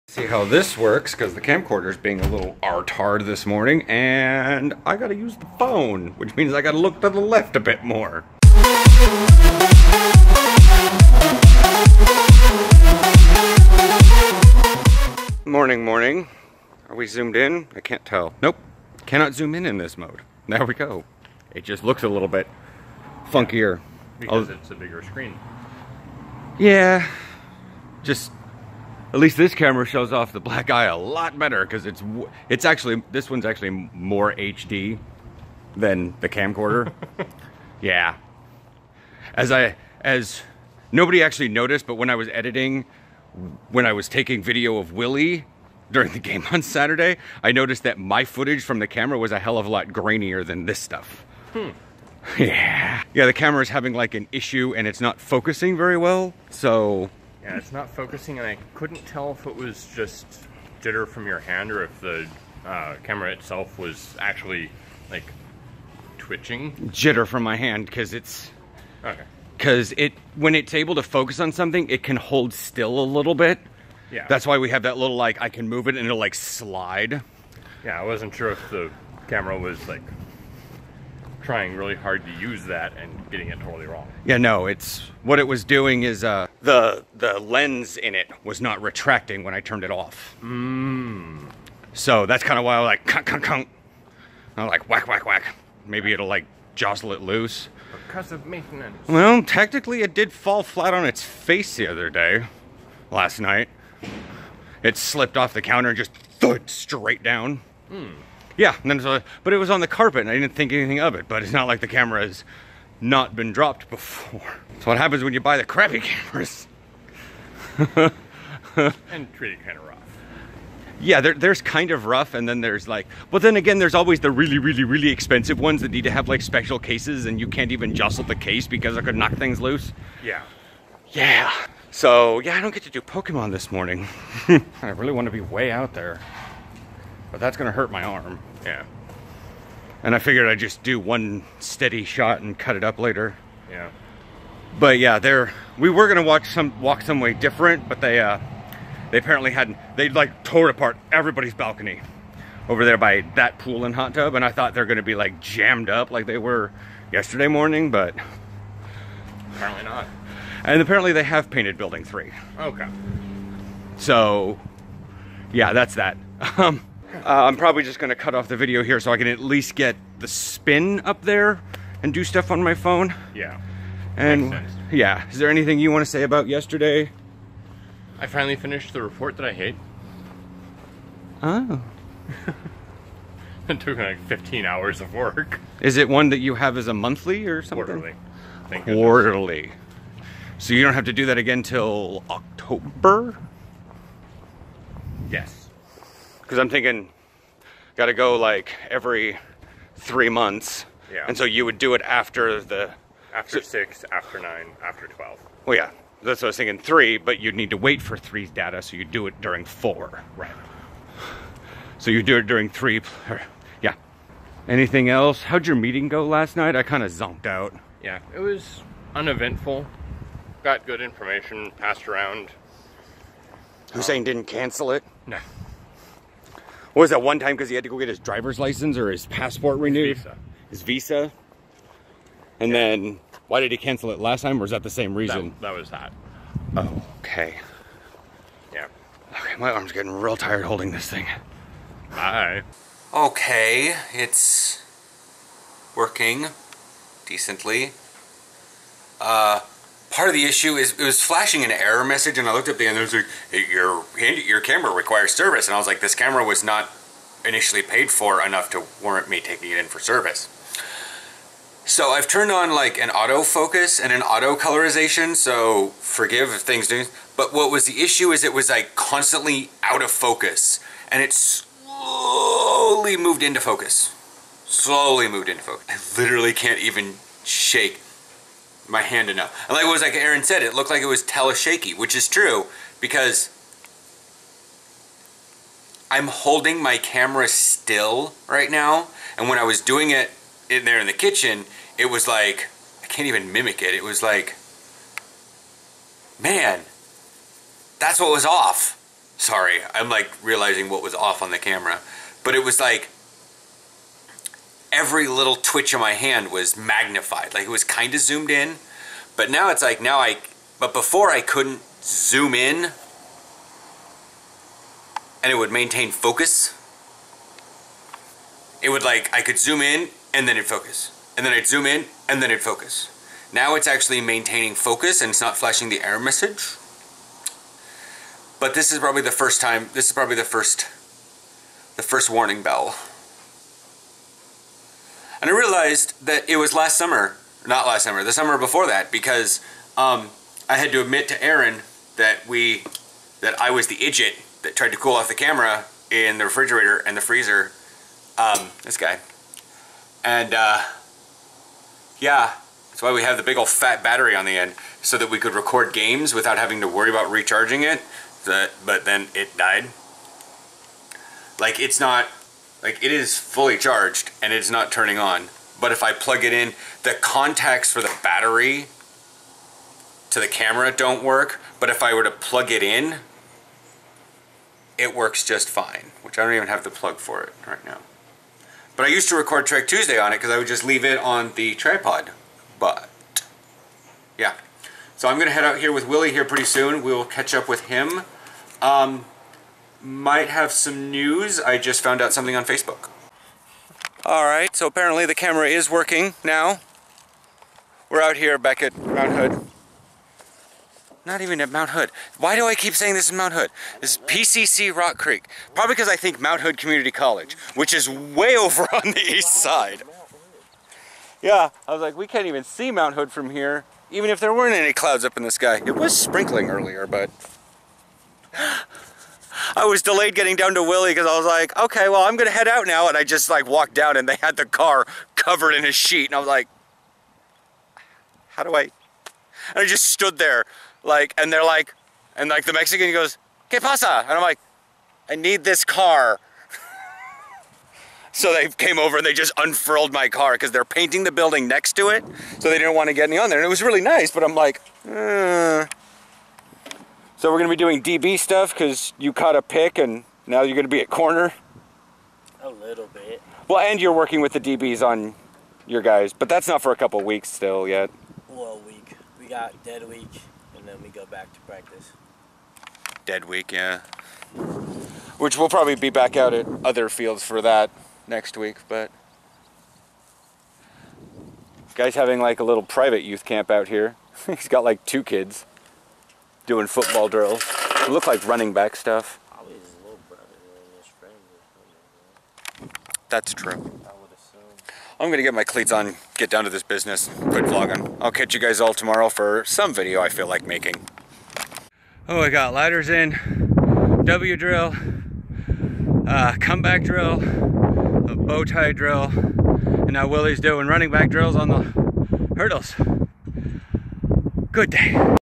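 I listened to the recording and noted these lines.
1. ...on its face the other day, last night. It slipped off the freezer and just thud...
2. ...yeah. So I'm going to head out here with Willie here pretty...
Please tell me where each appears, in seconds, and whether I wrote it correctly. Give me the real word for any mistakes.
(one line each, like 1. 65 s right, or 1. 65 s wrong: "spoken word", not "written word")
1. 100 s wrong: "counter", not "freezer"
2. 384 s right.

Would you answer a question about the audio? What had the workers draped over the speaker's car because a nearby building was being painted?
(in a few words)
A sheet.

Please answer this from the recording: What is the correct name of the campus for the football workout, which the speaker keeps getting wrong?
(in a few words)
PCC Rock Creek.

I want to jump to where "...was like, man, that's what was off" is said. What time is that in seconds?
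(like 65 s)
294 s.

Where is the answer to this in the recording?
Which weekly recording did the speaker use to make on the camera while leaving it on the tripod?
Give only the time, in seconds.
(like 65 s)
379 s.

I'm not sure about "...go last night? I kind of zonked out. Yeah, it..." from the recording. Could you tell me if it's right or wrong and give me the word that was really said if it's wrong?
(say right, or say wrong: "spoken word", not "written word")
right.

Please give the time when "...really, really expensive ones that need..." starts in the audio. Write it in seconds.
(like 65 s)
124 s.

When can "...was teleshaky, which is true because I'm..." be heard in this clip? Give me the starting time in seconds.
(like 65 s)
281 s.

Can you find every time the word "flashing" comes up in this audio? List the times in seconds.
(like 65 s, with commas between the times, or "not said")
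251 s, 325 s.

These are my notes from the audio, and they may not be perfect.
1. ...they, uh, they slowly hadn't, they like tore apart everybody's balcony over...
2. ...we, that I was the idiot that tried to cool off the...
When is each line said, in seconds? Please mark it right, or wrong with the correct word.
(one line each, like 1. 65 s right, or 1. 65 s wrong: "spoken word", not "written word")
1. 148 s wrong: "apparently", not "slowly"
2. 342 s right.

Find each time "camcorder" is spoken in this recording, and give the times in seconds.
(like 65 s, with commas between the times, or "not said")
1 s, 36 s.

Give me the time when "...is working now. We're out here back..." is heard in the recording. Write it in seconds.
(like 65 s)
395 s.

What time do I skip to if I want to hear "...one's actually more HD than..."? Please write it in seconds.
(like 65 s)
33 s.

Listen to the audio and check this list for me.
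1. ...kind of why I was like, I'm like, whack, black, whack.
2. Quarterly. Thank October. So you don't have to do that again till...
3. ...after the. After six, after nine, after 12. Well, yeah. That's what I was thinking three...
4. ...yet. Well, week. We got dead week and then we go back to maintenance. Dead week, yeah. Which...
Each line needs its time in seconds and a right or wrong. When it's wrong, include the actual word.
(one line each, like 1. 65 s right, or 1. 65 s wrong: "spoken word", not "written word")
1. 92 s wrong: "whack", not "black"
2. 187 s wrong: "Quarterly", not "October"
3. 202 s right
4. 457 s wrong: "practice", not "maintenance".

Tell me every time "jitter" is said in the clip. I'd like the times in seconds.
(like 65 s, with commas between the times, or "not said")
60 s, 66 s.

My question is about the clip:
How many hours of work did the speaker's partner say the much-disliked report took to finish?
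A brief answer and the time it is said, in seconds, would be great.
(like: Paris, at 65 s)
15, at 184 s.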